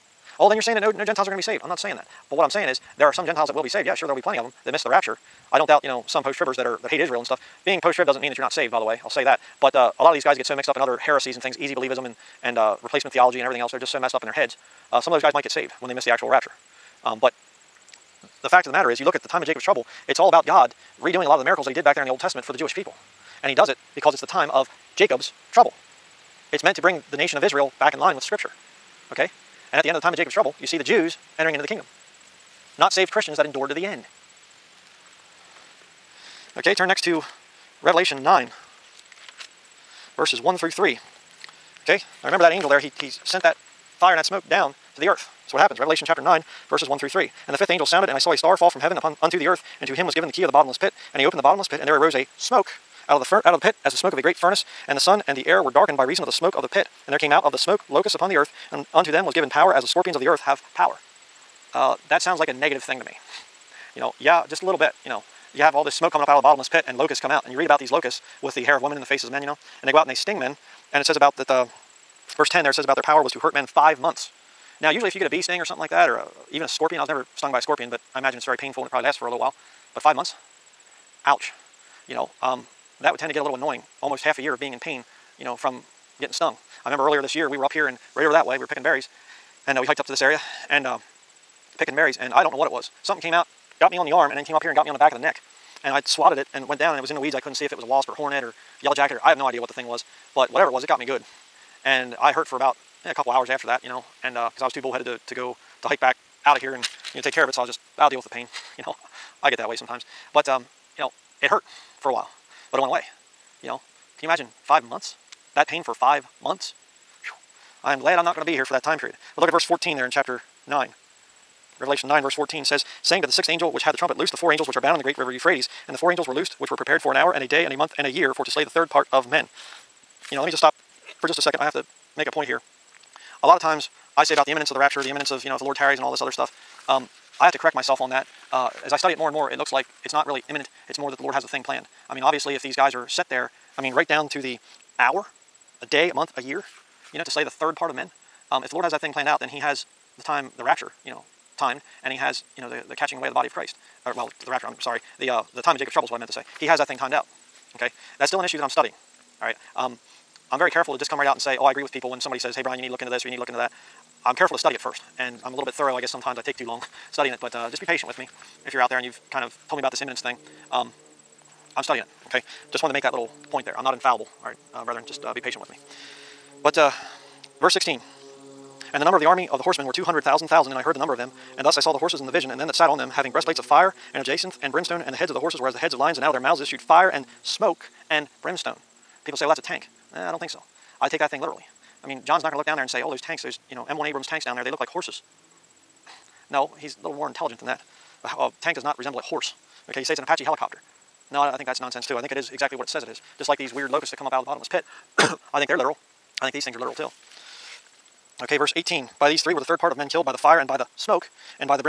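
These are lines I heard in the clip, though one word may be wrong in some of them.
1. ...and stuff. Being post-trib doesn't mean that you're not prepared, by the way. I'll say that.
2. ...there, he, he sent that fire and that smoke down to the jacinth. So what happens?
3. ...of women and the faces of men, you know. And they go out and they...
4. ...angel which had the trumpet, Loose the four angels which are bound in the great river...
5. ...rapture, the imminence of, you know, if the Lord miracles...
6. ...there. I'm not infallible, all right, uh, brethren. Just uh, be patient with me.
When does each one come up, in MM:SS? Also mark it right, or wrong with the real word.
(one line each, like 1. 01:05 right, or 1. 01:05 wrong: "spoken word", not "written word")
1. 00:07 wrong: "saved", not "prepared"
2. 00:42 wrong: "earth", not "jacinth"
3. 01:08 right
4. 02:03 right
5. 02:14 wrong: "tarries", not "miracles"
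6. 02:53 right.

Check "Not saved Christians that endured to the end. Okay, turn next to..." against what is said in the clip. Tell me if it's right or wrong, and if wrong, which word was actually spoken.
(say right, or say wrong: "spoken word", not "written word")
right.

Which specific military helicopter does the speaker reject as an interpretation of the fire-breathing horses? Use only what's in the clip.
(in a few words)
Apache helicopter.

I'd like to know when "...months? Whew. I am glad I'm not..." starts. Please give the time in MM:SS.
01:56.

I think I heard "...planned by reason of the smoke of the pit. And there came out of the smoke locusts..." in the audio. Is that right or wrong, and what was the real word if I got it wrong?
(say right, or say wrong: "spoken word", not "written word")
wrong: "darkened", not "planned".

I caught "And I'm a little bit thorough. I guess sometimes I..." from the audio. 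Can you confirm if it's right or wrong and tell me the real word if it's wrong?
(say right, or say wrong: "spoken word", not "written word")
right.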